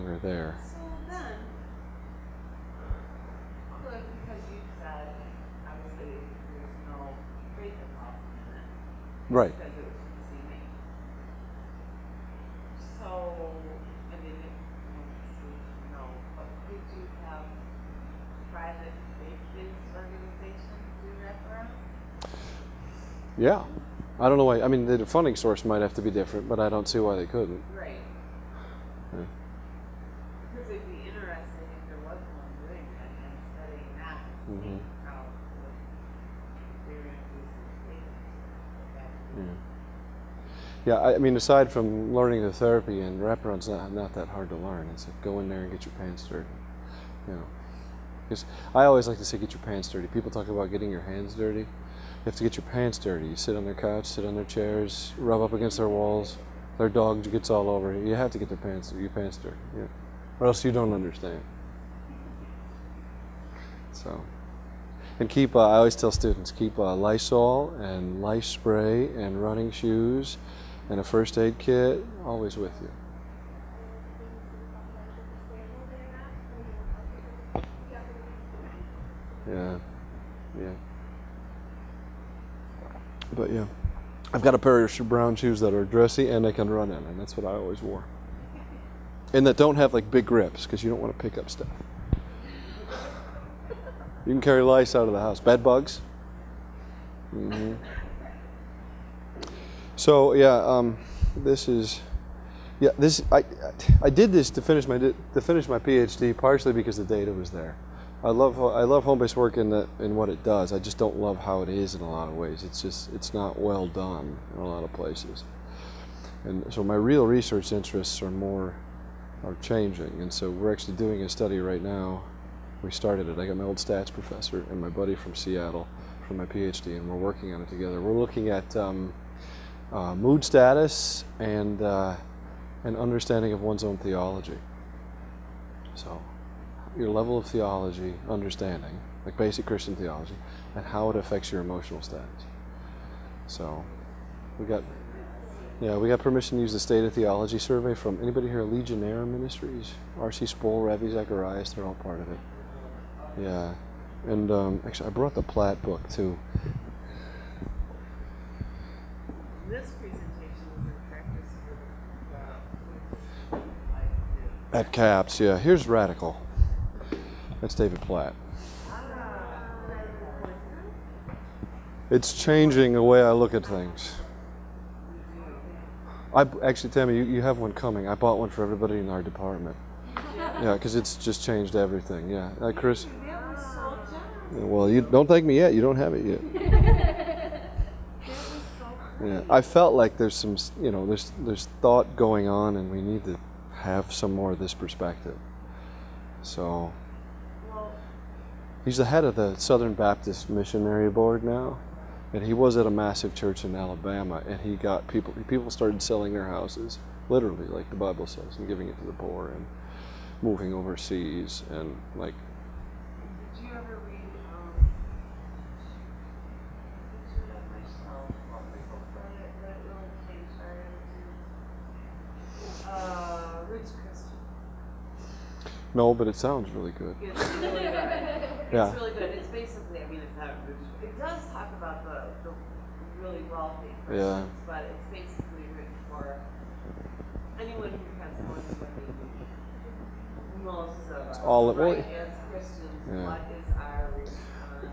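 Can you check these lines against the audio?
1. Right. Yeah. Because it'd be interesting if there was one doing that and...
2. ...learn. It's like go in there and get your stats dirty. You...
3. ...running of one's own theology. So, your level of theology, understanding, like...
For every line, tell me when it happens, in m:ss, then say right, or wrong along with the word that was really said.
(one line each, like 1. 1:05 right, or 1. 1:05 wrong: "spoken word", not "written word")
1. 0:27 right
2. 0:44 wrong: "pants", not "stats"
3. 2:12 wrong: "understanding", not "running".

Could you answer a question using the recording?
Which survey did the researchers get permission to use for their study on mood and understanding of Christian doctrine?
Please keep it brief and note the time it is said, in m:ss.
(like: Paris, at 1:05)
State of Theology survey, at 2:26.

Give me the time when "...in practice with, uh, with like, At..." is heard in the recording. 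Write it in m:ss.
2:40.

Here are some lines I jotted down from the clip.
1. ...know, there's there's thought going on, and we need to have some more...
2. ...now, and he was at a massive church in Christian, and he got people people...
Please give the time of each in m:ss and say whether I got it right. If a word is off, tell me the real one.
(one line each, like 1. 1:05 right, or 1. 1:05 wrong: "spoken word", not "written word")
1. 3:10 right
2. 3:21 wrong: "Alabama", not "Christian".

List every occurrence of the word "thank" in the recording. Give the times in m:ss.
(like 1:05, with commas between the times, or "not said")
3:05.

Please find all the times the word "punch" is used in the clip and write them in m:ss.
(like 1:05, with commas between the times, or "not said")
not said.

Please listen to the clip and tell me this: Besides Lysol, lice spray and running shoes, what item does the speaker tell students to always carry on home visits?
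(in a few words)
first aid kit.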